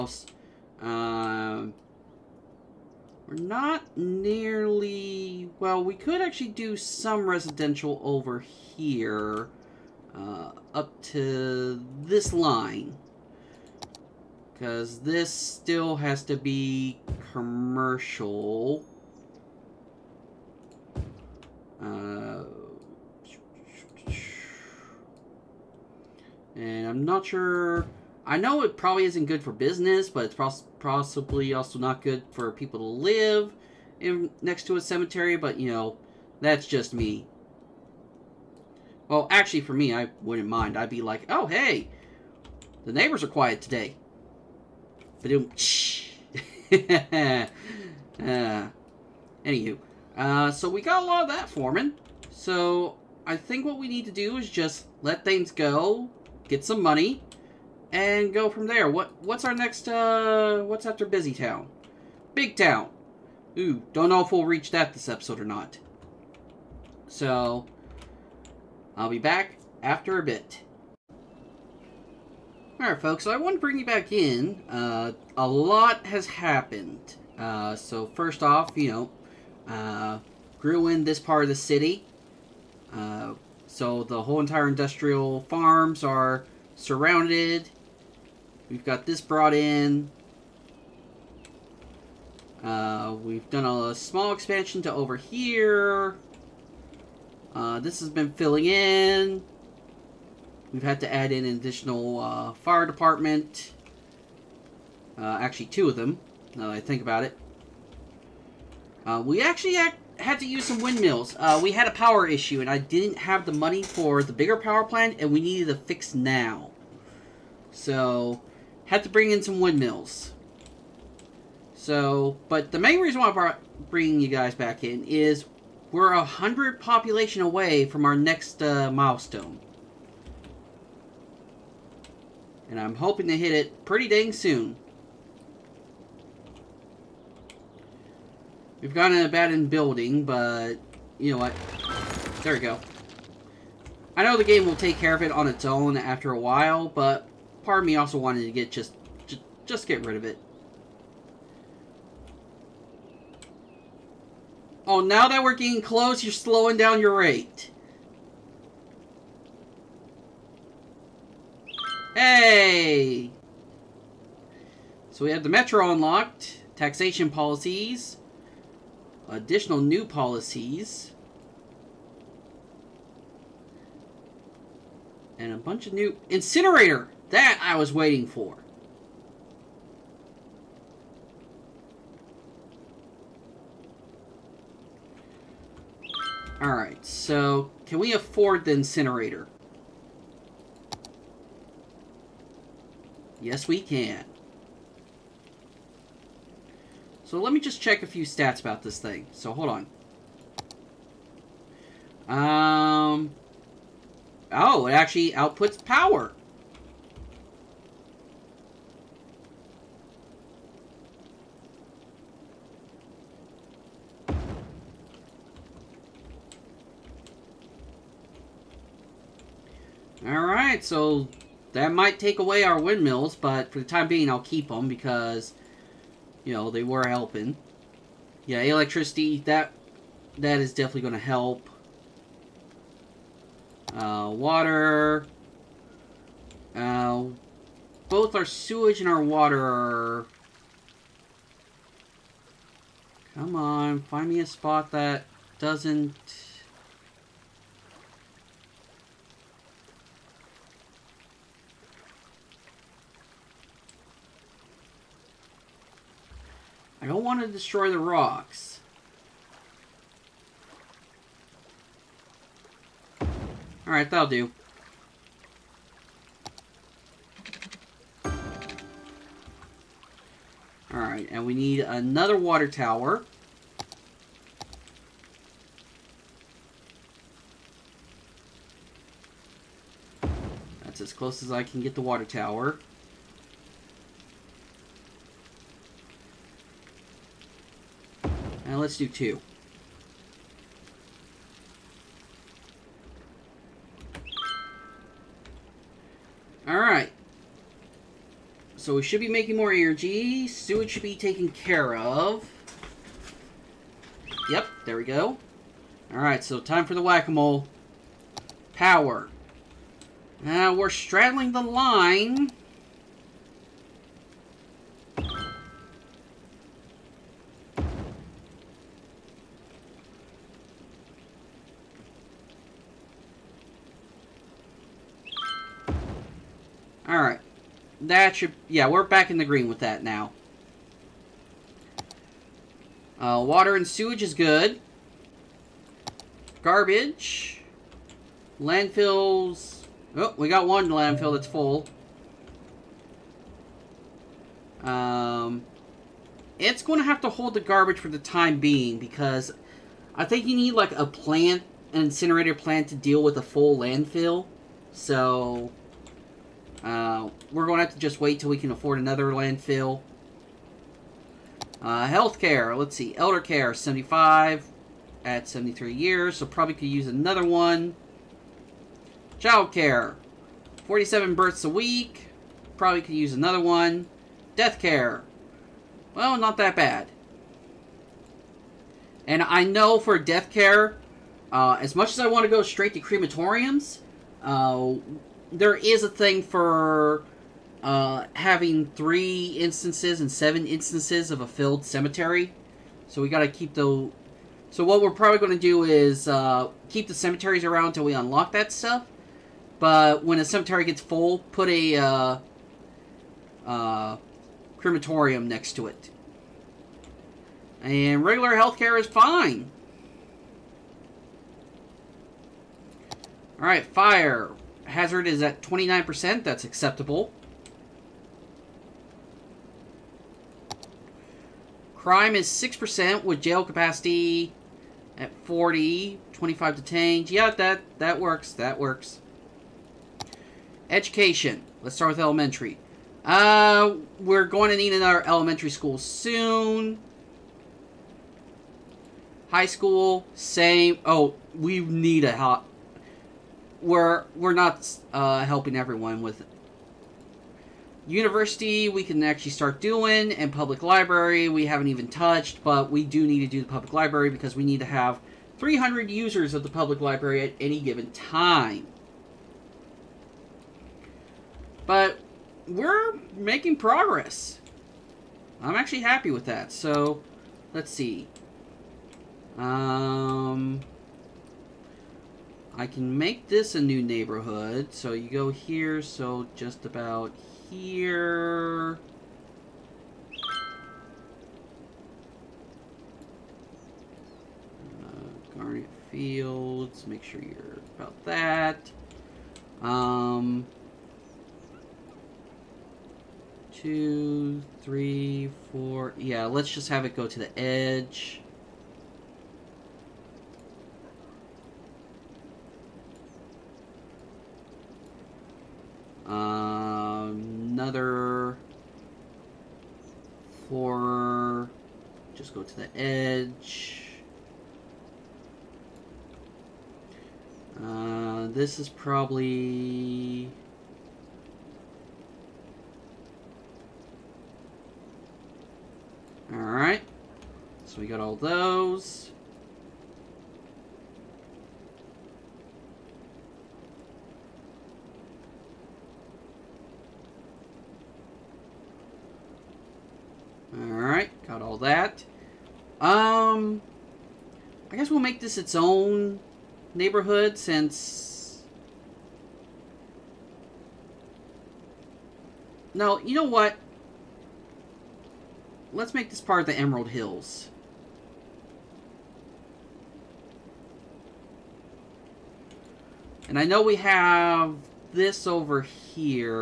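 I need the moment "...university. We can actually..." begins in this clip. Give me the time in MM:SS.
07:28.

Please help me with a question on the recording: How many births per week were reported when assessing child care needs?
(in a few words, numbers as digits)
47.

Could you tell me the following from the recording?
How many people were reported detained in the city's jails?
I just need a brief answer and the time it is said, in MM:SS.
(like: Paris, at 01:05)
25, at 07:06.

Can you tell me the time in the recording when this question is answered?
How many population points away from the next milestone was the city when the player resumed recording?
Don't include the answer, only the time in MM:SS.
02:06.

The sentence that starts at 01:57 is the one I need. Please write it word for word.
So, had to bring in some windmills.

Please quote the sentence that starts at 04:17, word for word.
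don't want to destroy the rocks.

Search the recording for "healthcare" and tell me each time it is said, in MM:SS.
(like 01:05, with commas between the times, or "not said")
06:02, 06:48.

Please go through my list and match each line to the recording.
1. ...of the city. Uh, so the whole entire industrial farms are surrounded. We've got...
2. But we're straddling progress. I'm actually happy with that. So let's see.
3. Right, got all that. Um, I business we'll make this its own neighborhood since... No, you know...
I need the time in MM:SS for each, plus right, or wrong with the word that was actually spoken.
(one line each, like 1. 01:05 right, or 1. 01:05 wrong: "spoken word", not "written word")
1. 01:21 right
2. 07:41 wrong: "making", not "straddling"
3. 09:01 wrong: "guess", not "business".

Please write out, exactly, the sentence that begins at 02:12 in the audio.
And I'm hoping to hit it pretty dang soon.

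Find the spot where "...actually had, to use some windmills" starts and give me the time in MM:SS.
01:49.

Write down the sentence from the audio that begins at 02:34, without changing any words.
Oh, now that we're getting close, you're slowing down your rate.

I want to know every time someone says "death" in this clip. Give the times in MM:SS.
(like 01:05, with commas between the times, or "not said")
06:14, 06:20.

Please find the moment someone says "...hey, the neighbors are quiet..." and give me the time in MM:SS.
00:41.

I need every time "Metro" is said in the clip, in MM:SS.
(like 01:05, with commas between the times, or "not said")
02:45.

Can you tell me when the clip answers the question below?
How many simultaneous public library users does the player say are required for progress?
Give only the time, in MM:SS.
07:35.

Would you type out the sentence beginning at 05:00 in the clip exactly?
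Sewage should be taken care of.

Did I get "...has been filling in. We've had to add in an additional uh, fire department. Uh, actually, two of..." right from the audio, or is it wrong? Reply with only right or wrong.
right.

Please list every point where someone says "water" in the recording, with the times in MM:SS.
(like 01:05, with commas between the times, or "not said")
03:54, 03:59, 04:32, 04:42, 05:33.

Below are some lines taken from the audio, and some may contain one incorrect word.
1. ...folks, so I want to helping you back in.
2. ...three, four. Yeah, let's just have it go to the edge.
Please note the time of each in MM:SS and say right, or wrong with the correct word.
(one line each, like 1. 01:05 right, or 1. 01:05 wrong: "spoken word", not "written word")
1. 01:12 wrong: "bring", not "helping"
2. 08:14 right.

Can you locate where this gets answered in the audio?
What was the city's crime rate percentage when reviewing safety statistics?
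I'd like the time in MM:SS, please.
07:02.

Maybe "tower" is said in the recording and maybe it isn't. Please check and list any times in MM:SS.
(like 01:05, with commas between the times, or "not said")
04:32, 04:42.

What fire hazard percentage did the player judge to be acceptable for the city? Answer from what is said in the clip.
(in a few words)
29%.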